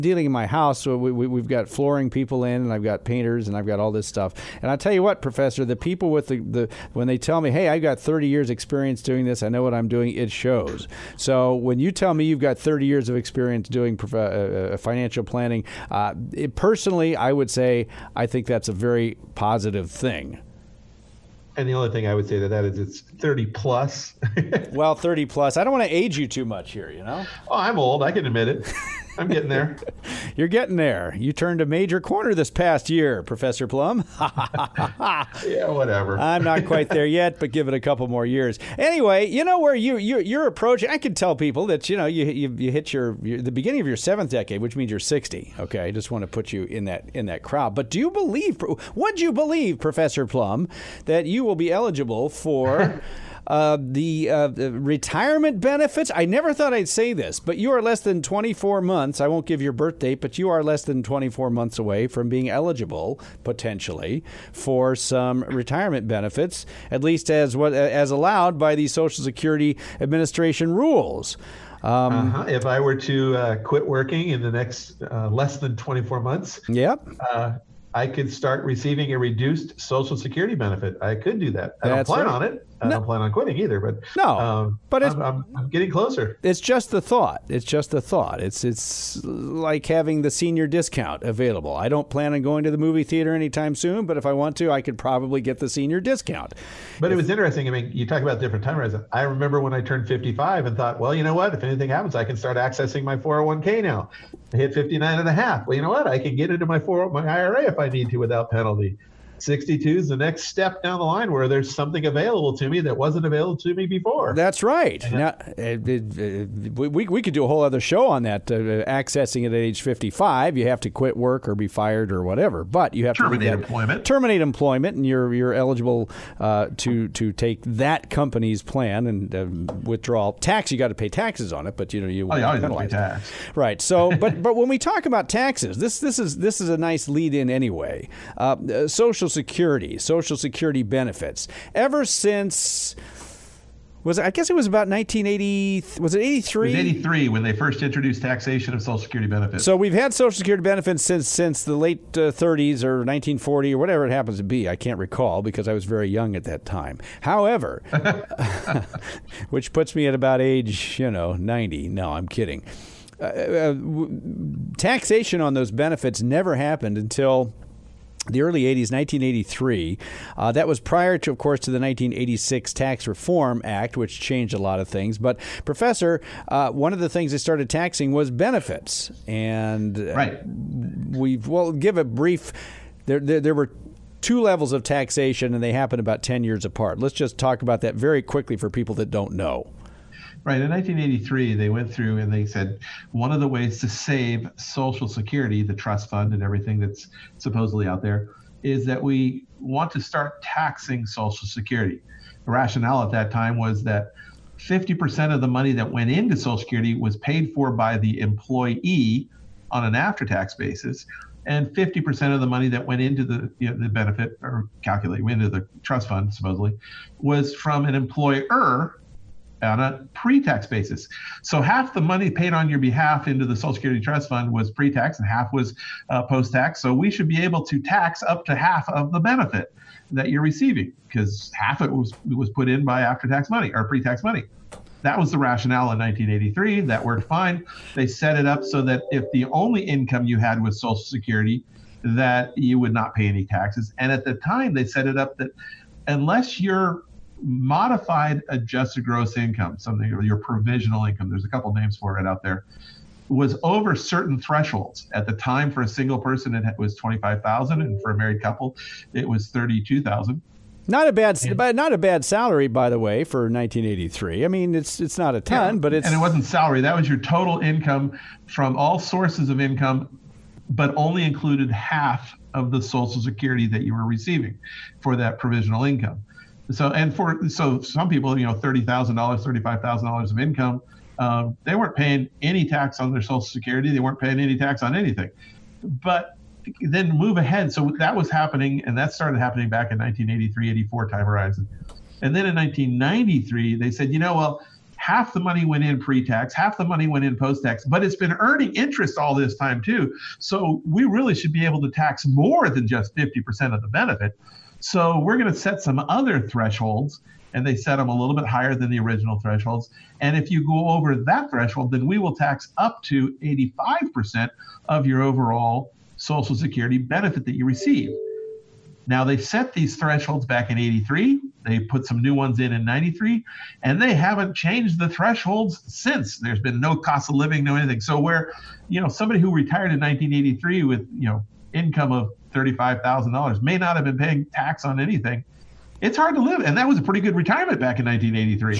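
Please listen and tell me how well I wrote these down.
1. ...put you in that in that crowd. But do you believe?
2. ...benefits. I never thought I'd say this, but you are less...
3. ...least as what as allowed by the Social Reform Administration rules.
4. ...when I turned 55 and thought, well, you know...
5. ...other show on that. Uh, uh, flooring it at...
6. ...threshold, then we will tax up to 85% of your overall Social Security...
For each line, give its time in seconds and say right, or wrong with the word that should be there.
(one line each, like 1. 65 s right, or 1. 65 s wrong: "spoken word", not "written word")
1. 46 s right
2. 55 s right
3. 67 s wrong: "Security", not "Reform"
4. 99 s right
5. 117 s wrong: "accessing", not "flooring"
6. 311 s right.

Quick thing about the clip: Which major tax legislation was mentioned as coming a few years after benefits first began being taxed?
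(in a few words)
1986 Tax Reform Act.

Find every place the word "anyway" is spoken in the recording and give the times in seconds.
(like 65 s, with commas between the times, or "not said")
38 s, 137 s.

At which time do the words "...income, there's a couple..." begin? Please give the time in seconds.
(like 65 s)
251 s.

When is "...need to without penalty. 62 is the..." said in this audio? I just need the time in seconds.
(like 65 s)
107 s.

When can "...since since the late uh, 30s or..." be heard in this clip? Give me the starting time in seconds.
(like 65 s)
151 s.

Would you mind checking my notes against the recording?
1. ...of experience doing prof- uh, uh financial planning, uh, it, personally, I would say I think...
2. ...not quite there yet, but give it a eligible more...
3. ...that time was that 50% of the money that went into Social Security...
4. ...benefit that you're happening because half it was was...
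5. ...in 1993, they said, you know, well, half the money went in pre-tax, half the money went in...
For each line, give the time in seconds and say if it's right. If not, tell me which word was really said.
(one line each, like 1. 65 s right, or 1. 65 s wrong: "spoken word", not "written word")
1. 13 s right
2. 36 s wrong: "couple", not "eligible"
3. 203 s right
4. 229 s wrong: "receiving", not "happening"
5. 292 s right.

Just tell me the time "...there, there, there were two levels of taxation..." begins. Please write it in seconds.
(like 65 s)
183 s.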